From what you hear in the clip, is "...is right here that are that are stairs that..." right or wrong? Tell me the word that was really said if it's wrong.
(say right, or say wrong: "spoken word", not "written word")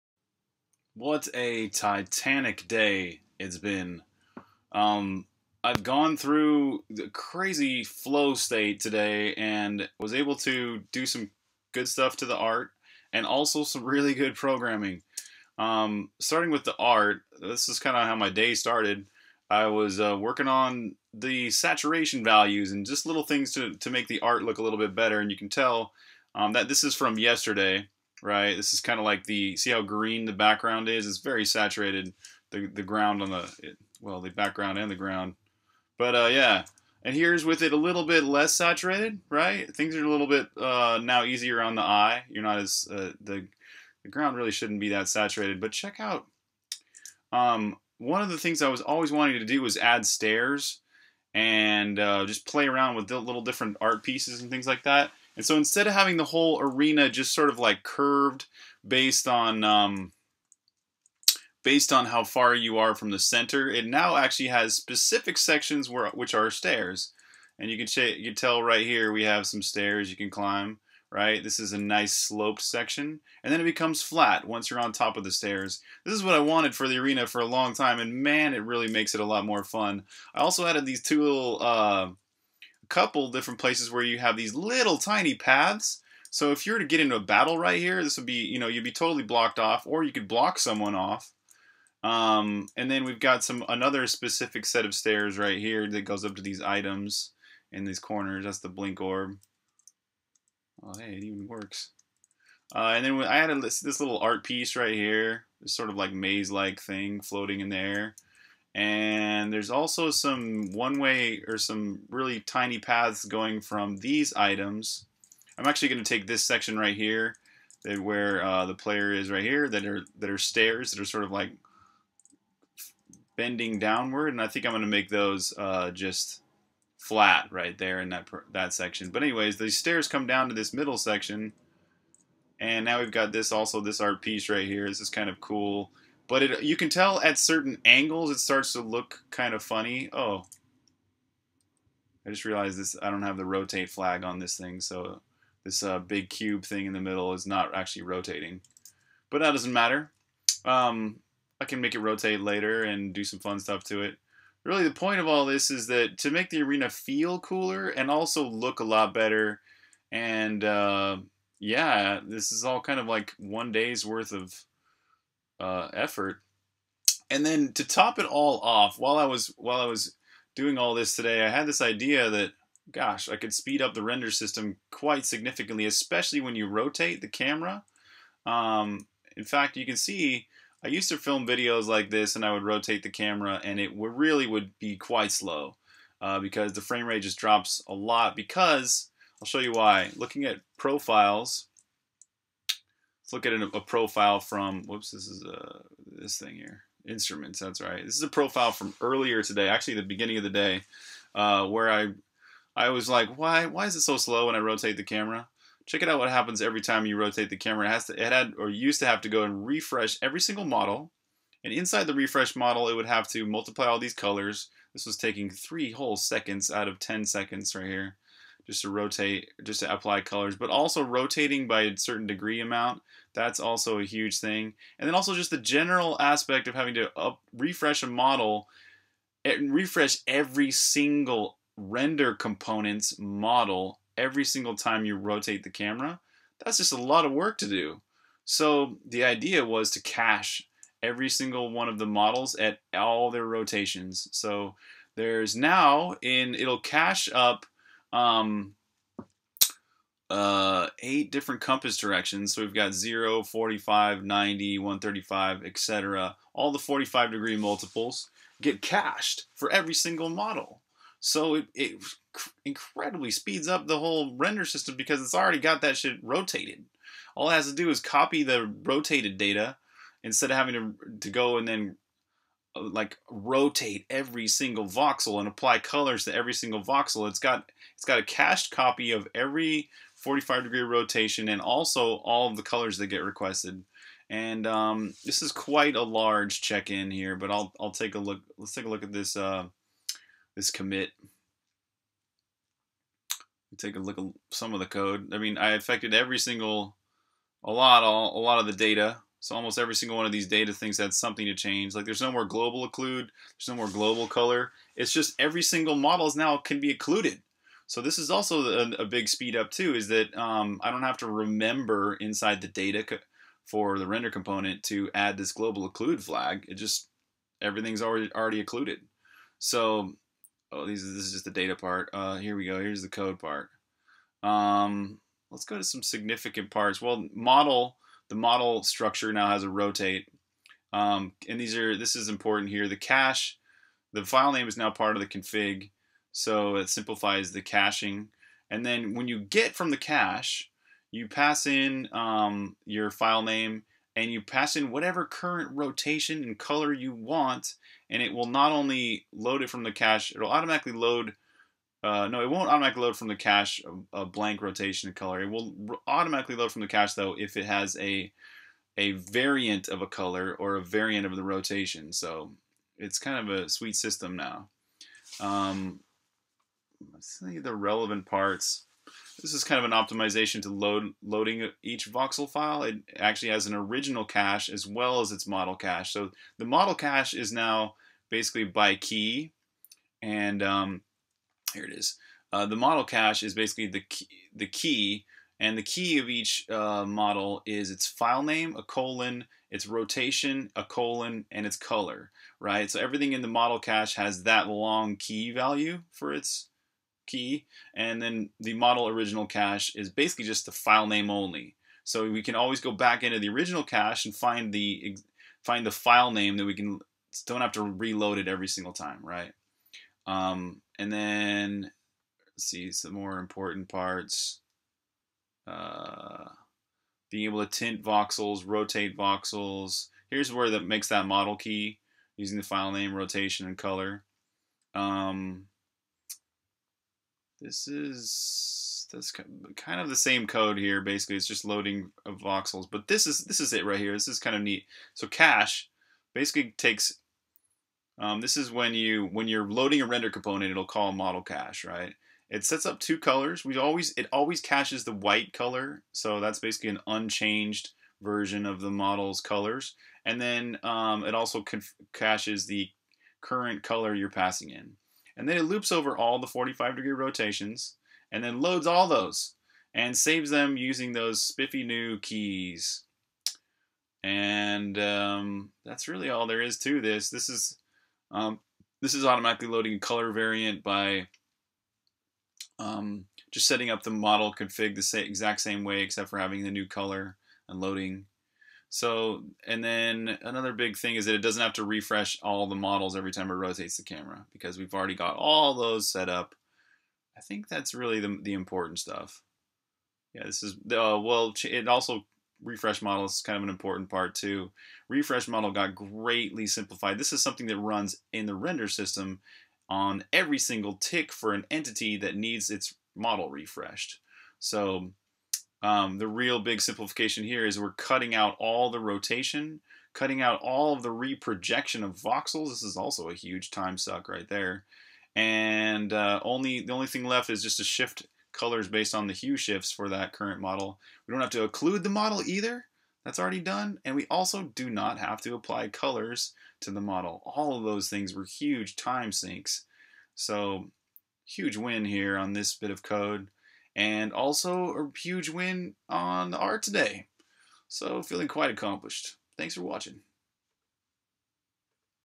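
right.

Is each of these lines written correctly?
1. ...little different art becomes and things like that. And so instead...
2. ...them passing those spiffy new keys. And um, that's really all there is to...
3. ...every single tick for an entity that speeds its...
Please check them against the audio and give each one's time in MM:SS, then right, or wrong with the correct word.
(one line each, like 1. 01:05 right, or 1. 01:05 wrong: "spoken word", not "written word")
1. 00:53 wrong: "pieces", not "becomes"
2. 07:40 wrong: "using", not "passing"
3. 08:20 wrong: "needs", not "speeds".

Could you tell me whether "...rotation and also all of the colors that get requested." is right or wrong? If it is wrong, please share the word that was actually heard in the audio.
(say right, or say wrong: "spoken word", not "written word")
right.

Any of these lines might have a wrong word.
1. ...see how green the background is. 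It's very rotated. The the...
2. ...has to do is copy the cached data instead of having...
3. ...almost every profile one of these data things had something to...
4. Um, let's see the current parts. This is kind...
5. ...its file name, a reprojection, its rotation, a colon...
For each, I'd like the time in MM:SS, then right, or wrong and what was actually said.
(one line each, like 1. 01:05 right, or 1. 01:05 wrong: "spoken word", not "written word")
1. 00:29 wrong: "saturated", not "rotated"
2. 04:27 wrong: "rotated", not "cached"
3. 04:59 wrong: "single", not "profile"
4. 06:05 wrong: "relevant", not "current"
5. 06:27 wrong: "colon", not "reprojection".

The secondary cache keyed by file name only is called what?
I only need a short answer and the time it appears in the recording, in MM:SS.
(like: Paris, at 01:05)
Model original cache, at 06:38.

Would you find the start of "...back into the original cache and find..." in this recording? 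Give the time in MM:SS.
06:42.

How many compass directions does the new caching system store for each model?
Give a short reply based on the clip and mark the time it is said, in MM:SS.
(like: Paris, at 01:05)
8, at 04:11.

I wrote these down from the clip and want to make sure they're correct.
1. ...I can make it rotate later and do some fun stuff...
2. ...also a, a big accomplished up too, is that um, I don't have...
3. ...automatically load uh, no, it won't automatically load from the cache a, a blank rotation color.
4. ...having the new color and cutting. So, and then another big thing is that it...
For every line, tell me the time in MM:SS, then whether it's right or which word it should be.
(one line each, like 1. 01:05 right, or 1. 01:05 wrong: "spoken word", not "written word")
1. 02:31 right
2. 05:08 wrong: "speed", not "accomplished"
3. 05:50 right
4. 07:56 wrong: "loading", not "cutting".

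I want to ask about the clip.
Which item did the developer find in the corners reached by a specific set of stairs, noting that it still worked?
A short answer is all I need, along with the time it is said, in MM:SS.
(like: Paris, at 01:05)
Blink orb, at 01:38.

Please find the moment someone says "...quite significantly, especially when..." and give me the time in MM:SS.
02:54.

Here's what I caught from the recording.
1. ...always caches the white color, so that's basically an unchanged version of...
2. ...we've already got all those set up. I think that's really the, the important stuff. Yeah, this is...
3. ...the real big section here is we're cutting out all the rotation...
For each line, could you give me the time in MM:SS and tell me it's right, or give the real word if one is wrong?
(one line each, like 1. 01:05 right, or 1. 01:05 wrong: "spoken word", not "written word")
1. 07:24 right
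2. 08:04 right
3. 08:26 wrong: "simplification", not "section".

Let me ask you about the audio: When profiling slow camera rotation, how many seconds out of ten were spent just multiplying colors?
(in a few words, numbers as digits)
3 seconds.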